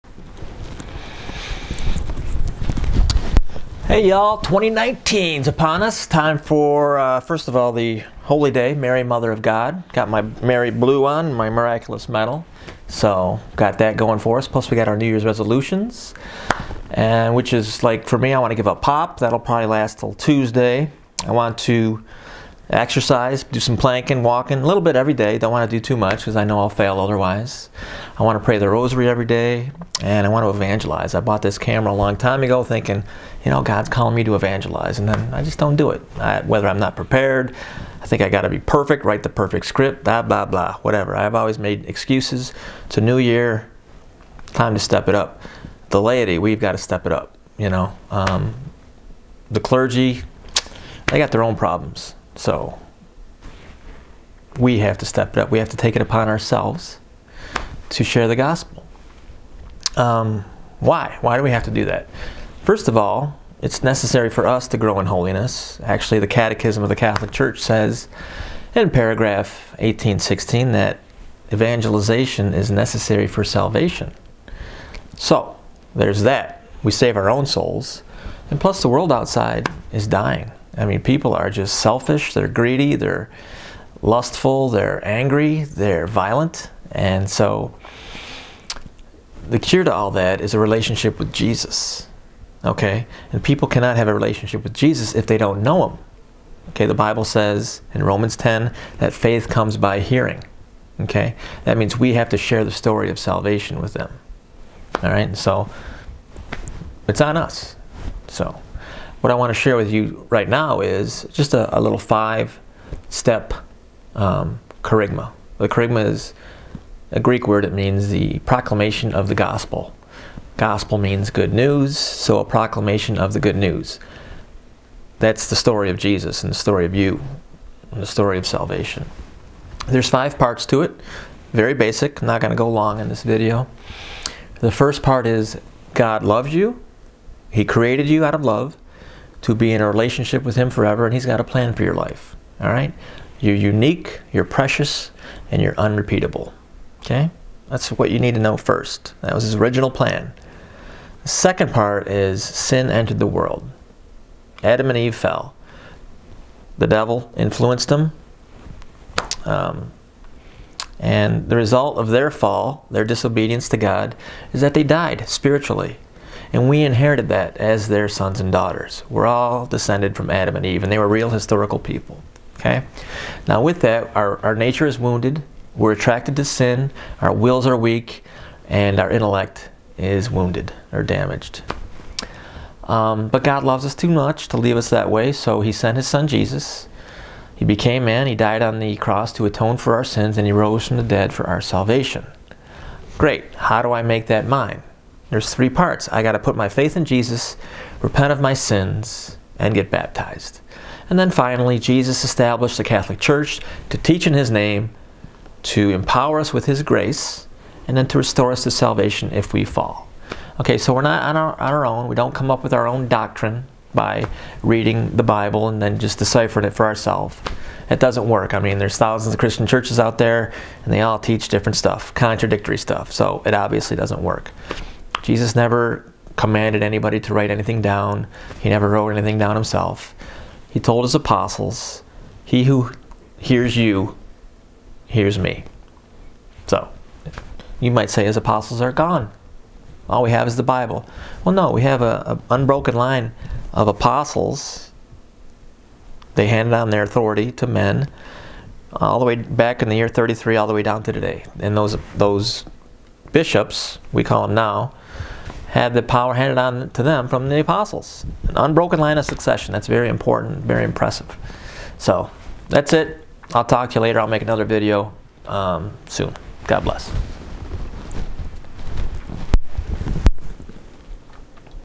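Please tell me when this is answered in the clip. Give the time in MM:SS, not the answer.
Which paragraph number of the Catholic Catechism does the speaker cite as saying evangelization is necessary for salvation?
01:09.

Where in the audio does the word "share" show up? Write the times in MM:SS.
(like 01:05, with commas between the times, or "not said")
00:58, 01:42, 01:49.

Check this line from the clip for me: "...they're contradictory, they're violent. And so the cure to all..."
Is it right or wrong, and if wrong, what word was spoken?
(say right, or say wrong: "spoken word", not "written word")
wrong: "angry", not "contradictory".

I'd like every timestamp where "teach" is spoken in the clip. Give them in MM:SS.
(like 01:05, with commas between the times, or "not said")
03:23, 03:41.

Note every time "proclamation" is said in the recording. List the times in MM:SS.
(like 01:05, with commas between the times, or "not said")
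01:58, 02:02.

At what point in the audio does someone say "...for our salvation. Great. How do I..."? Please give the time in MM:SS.
03:11.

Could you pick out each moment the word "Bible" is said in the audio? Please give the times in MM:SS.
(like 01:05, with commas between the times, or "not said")
01:36, 03:35, 04:00.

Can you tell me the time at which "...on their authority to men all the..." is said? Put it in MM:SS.
04:06.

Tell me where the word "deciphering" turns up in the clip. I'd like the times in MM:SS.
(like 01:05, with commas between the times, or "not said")
03:36.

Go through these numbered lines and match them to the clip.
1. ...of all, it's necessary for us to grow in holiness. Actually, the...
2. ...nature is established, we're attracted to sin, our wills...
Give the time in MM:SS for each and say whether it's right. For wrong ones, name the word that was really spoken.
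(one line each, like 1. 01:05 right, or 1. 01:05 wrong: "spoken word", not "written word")
1. 01:02 right
2. 02:54 wrong: "wounded", not "established".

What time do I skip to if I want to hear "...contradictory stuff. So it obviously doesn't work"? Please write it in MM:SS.
03:42.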